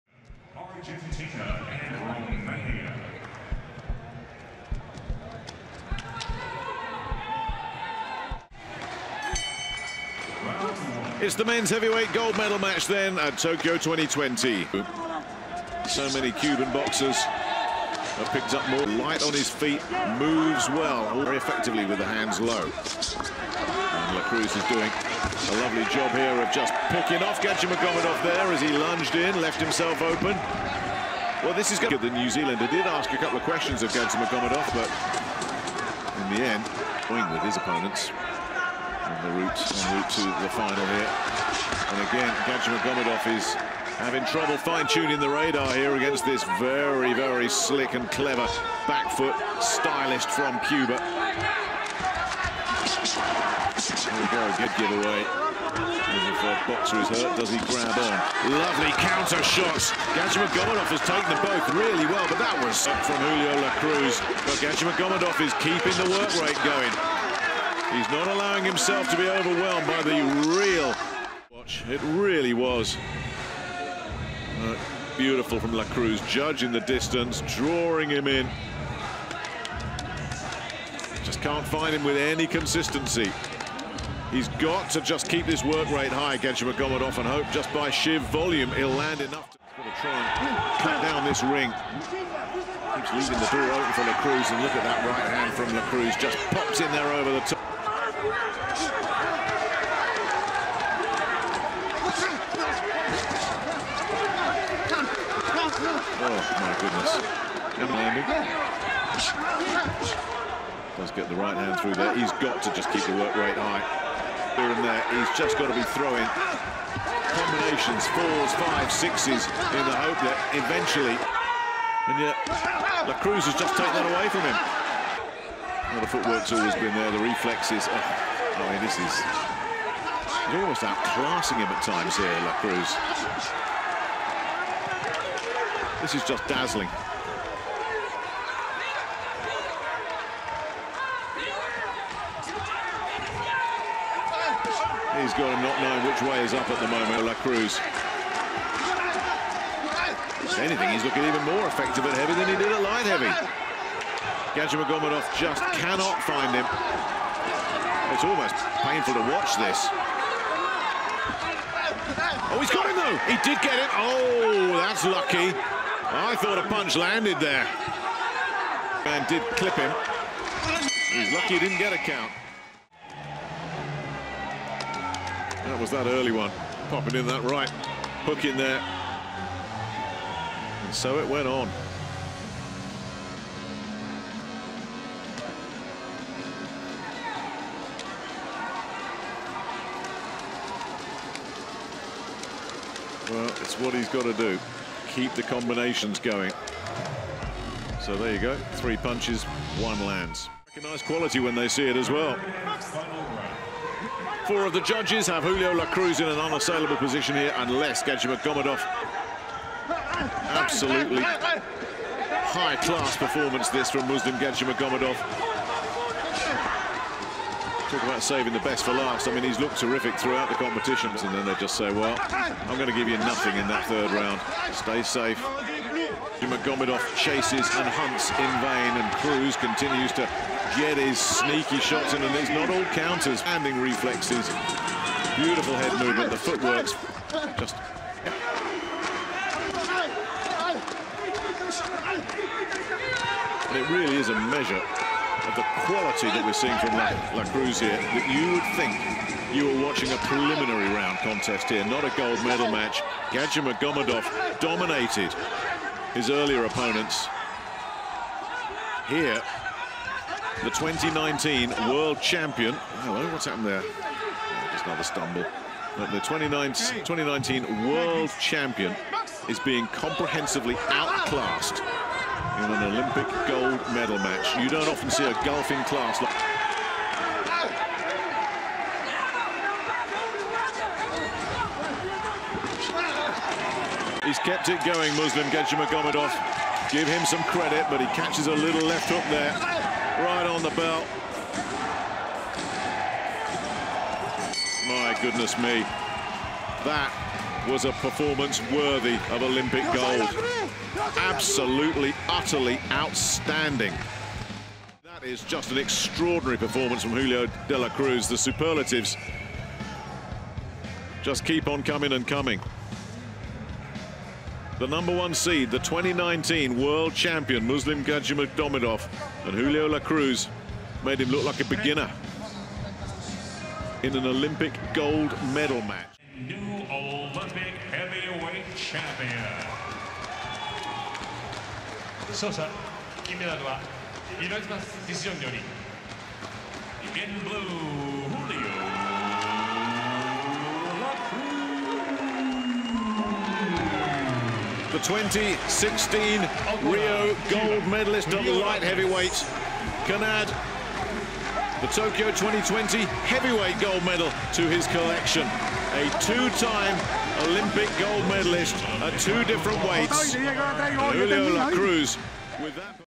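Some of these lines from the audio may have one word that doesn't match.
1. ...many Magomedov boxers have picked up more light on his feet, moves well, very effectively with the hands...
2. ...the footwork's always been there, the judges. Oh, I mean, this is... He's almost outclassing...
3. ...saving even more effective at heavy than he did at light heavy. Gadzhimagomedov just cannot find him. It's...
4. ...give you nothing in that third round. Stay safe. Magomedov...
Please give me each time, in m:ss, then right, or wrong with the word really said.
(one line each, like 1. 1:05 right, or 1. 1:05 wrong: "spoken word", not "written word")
1. 0:16 wrong: "Cuban", not "Magomedov"
2. 2:06 wrong: "reflexes", not "judges"
3. 2:31 wrong: "looking", not "saving"
4. 3:42 right.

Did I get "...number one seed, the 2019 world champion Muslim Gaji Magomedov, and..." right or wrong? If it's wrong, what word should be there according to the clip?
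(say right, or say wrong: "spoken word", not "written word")
right.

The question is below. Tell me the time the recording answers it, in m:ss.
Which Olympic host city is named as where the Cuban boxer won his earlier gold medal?
5:46.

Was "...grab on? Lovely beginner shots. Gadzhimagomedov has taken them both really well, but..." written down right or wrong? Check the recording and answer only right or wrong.
wrong.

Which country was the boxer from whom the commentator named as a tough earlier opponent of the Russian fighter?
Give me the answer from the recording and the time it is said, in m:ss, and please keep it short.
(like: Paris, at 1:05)
New Zealand, at 0:32.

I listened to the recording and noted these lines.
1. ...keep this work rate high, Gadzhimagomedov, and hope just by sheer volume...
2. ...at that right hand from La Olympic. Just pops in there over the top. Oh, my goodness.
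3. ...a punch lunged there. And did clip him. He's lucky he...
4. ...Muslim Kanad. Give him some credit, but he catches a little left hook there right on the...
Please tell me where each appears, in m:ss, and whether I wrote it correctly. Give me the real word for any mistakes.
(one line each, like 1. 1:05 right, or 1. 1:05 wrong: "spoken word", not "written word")
1. 1:25 right
2. 1:34 wrong: "Cruz", not "Olympic"
3. 2:46 wrong: "landed", not "lunged"
4. 4:45 wrong: "Gadzhimagomedov", not "Kanad".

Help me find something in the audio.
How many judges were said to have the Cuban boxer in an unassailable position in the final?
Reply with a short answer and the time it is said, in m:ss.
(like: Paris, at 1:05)
4, at 3:24.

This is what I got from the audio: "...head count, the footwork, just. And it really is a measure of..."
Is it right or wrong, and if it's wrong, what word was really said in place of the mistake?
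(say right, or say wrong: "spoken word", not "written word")
wrong: "movement", not "count".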